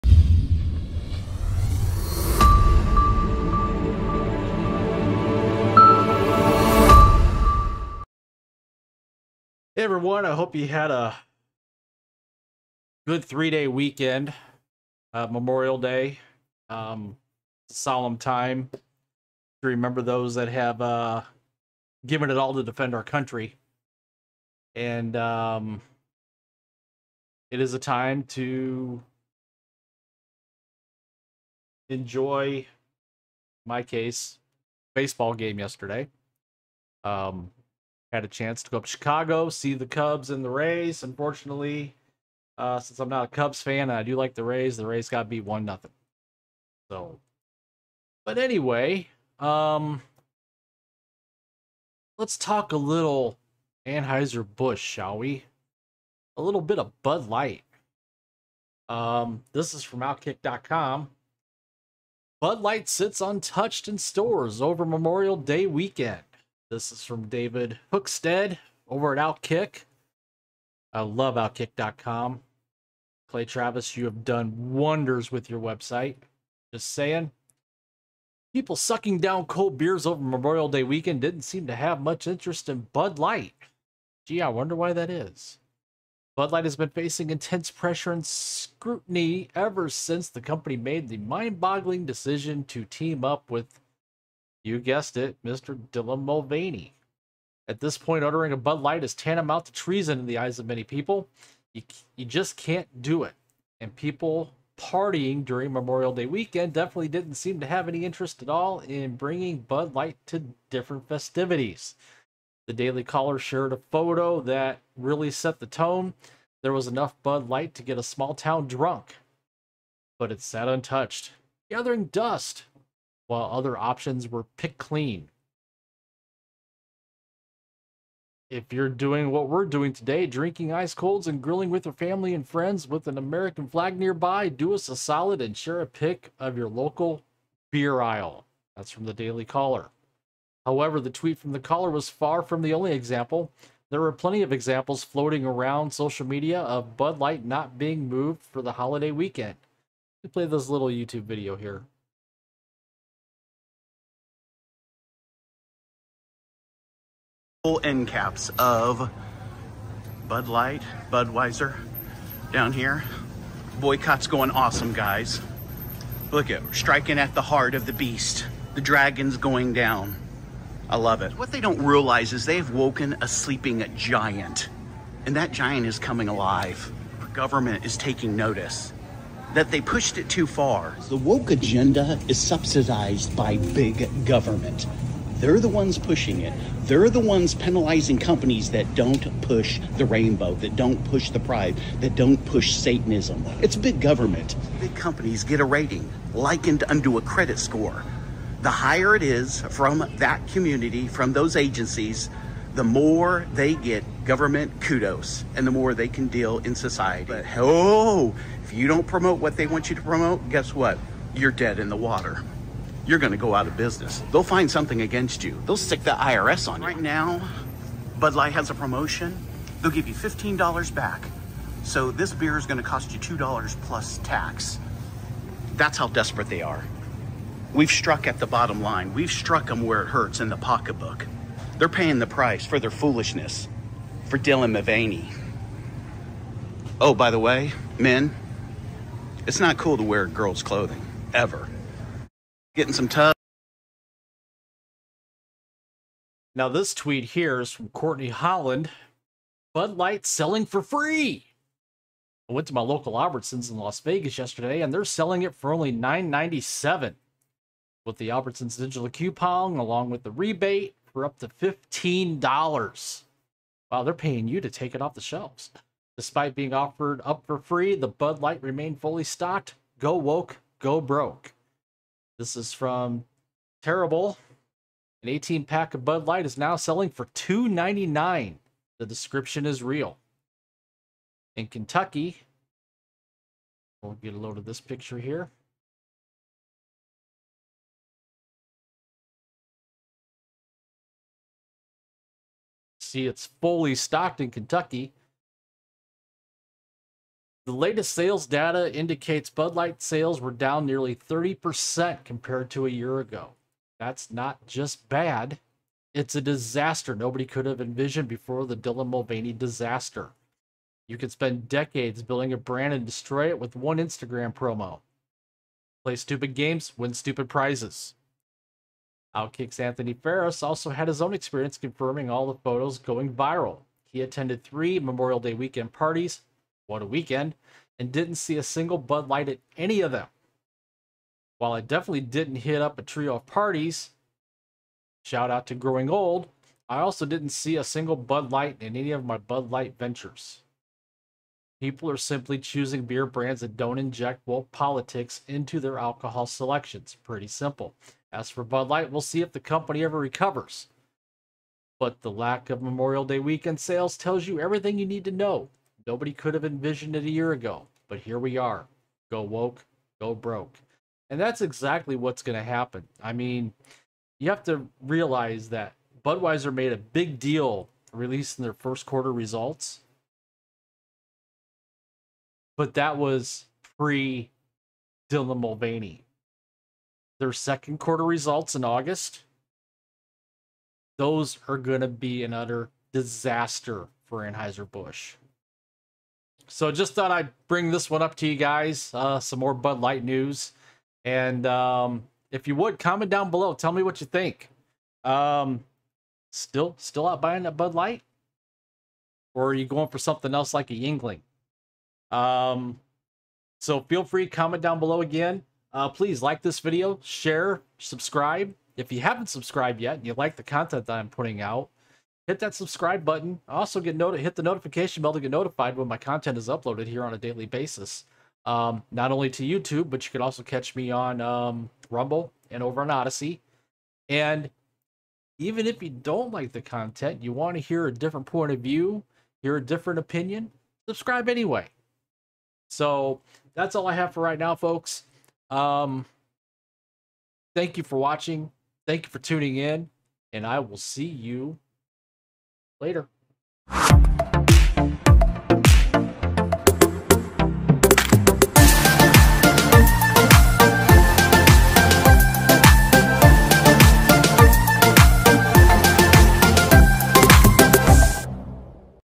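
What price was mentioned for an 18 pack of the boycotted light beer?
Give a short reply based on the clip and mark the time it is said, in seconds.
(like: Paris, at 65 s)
$2.99, at 277 s.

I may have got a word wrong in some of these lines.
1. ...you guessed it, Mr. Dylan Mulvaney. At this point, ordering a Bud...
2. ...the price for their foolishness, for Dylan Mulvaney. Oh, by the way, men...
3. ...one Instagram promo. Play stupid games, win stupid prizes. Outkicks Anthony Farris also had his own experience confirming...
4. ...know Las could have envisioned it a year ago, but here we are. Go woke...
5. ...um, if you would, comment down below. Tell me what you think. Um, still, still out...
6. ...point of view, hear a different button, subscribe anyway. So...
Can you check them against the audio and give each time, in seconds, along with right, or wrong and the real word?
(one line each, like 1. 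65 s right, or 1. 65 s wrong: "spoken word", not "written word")
1. 94 s right
2. 232 s right
3. 313 s right
4. 355 s wrong: "Nobody", not "Las"
5. 391 s right
6. 428 s wrong: "opinion", not "button".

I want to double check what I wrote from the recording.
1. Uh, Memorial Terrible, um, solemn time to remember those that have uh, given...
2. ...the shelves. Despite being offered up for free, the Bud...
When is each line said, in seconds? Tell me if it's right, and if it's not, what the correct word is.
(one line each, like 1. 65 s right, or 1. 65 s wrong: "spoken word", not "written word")
1. 15 s wrong: "Day", not "Terrible"
2. 265 s right.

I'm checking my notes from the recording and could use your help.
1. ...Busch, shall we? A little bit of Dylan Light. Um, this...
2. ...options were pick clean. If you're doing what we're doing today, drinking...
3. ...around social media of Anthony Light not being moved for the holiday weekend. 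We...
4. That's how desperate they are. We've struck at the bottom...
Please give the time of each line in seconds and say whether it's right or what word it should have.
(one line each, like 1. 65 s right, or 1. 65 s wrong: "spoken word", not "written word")
1. 54 s wrong: "Bud", not "Dylan"
2. 123 s right
3. 145 s wrong: "Bud", not "Anthony"
4. 225 s right.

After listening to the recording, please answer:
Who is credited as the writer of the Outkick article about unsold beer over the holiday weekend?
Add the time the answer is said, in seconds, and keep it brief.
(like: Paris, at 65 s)
David Hookstead, at 67 s.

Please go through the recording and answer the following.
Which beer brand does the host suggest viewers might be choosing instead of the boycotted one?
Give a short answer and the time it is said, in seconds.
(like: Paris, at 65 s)
Yuengling, at 400 s.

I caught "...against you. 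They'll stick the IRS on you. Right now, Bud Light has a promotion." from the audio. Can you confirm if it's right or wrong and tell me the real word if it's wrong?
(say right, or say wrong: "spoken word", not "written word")
right.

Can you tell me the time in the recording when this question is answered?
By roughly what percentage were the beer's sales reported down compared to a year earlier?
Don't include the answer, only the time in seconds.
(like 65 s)
301 s.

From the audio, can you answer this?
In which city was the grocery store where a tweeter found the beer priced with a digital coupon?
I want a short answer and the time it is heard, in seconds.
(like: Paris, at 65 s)
Las Vegas, at 253 s.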